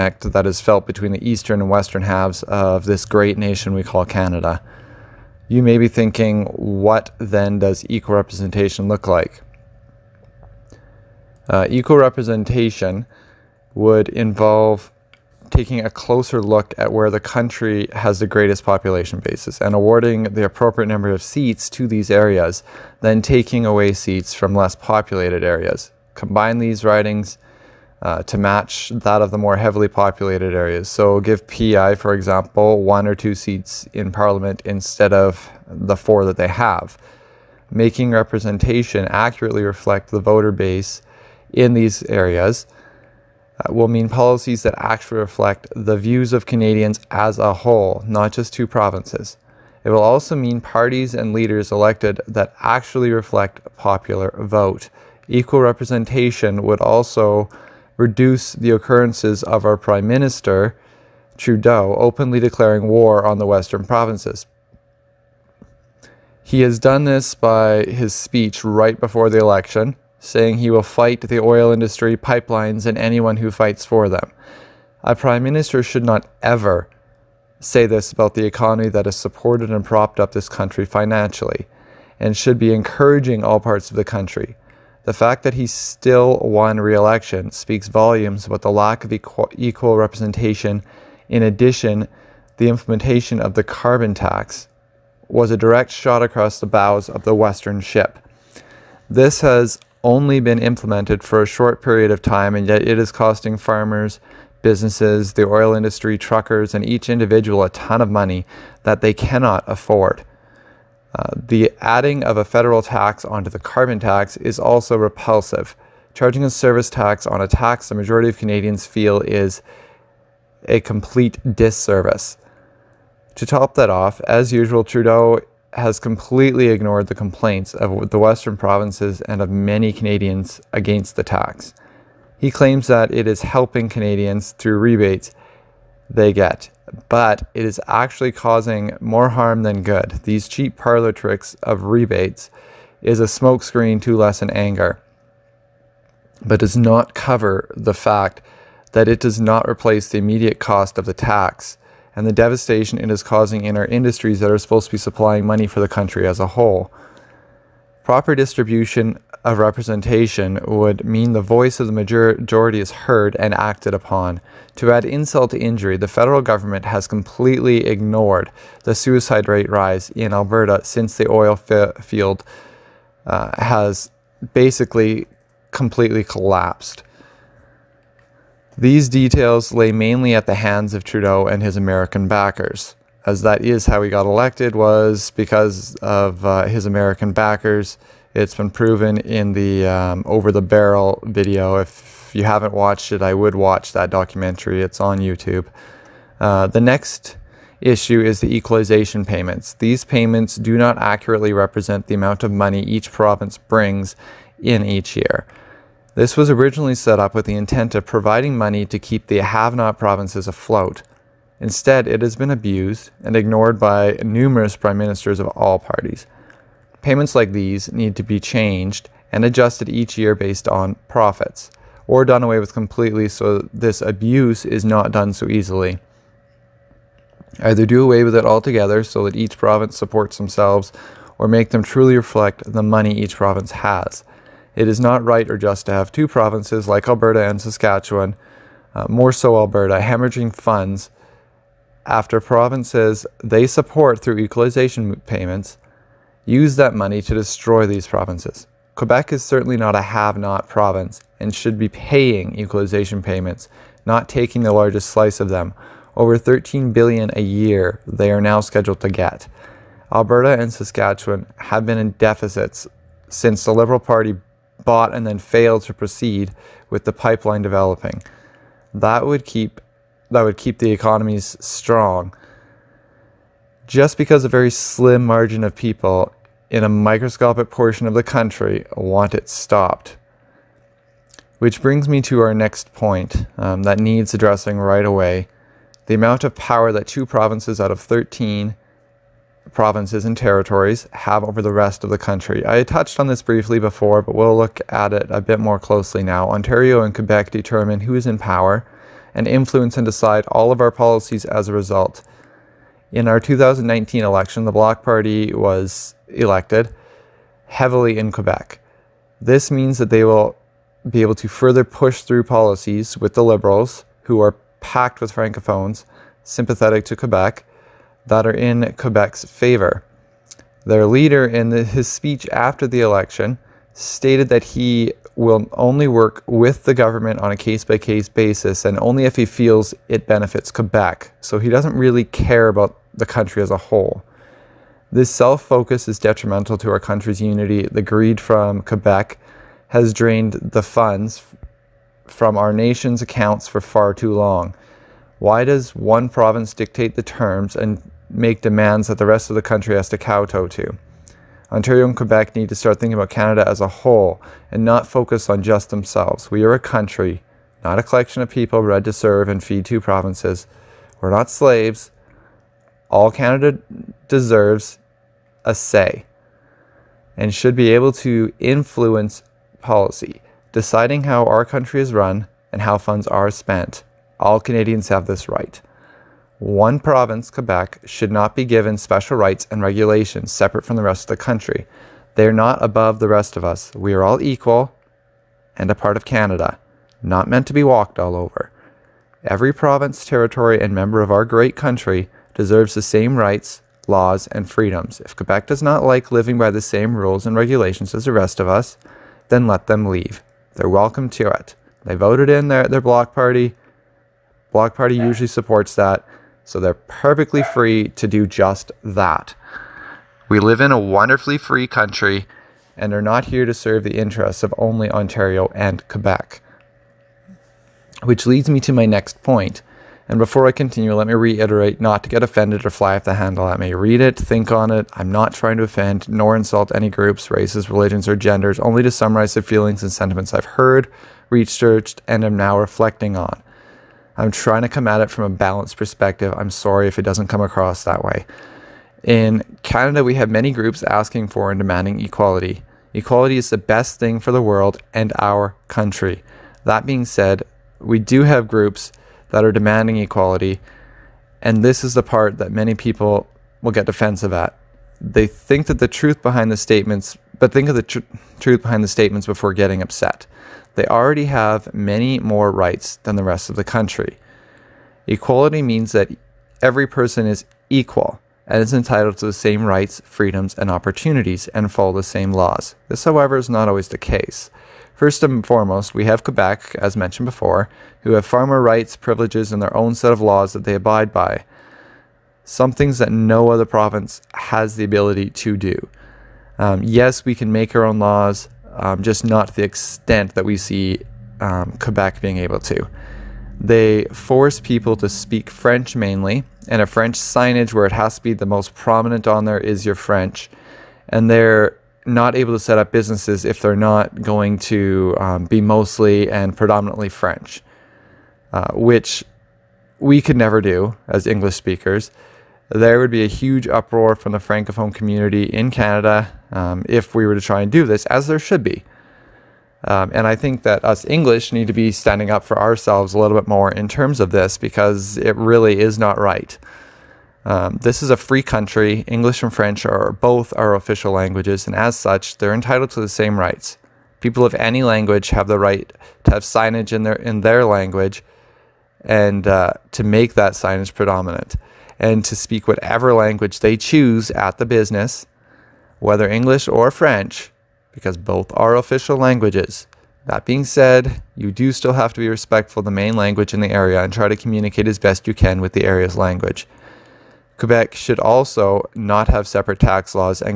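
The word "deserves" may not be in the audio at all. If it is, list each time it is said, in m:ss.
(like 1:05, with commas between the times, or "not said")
6:04, 6:32.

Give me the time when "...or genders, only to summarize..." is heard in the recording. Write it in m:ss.
7:08.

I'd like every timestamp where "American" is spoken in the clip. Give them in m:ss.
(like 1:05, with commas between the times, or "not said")
3:01, 3:06.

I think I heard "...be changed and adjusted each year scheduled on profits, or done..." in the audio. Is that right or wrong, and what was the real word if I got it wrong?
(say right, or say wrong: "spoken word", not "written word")
wrong: "based", not "scheduled".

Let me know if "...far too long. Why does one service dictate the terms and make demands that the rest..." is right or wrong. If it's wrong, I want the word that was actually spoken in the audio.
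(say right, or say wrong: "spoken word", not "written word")
wrong: "province", not "service".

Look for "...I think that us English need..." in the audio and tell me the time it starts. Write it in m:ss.
8:40.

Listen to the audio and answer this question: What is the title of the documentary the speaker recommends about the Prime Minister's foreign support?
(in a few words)
Over the Barrel.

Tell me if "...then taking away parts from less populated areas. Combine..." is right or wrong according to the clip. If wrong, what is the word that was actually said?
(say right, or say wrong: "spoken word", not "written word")
wrong: "seats", not "parts".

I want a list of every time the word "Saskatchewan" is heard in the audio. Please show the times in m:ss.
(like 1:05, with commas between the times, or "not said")
3:57, 4:20.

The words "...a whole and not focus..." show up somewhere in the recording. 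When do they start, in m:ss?
5:53.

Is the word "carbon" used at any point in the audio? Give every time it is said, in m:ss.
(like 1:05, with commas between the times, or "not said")
1:33, 1:53.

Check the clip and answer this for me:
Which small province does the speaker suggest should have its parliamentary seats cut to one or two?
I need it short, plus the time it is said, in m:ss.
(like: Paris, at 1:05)
PEI, at 0:31.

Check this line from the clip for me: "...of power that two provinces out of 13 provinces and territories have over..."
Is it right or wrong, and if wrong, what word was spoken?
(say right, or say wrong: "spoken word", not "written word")
right.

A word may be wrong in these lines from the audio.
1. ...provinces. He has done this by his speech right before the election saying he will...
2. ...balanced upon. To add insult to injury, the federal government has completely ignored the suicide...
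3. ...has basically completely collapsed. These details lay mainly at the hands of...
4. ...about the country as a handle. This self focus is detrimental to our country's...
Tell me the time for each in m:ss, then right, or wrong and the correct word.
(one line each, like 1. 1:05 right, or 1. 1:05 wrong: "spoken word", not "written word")
1. 1:03 right
2. 2:43 wrong: "acted", not "balanced"
3. 2:53 right
4. 5:32 wrong: "whole", not "handle".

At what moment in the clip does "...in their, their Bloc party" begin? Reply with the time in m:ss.
6:42.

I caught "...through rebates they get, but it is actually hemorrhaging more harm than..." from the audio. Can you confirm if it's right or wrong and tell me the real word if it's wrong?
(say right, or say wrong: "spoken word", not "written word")
wrong: "causing", not "hemorrhaging".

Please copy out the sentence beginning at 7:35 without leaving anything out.
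They think that the truth behind the statements but think of the tr truth behind the statements before getting upset.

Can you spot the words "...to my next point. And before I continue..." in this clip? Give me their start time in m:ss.
6:58.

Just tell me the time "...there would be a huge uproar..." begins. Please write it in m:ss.
8:32.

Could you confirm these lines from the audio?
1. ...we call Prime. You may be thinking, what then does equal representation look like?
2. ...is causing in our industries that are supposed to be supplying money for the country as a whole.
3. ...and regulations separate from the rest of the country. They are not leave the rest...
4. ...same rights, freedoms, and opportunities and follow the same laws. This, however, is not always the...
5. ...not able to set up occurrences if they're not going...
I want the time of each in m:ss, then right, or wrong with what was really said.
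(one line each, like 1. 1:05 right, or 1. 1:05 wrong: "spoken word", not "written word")
1. 0:03 wrong: "Canada", not "Prime"
2. 2:33 right
3. 6:19 wrong: "above", not "leave"
4. 7:49 right
5. 8:22 wrong: "businesses", not "occurrences".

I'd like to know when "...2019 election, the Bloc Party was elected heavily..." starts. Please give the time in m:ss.
5:03.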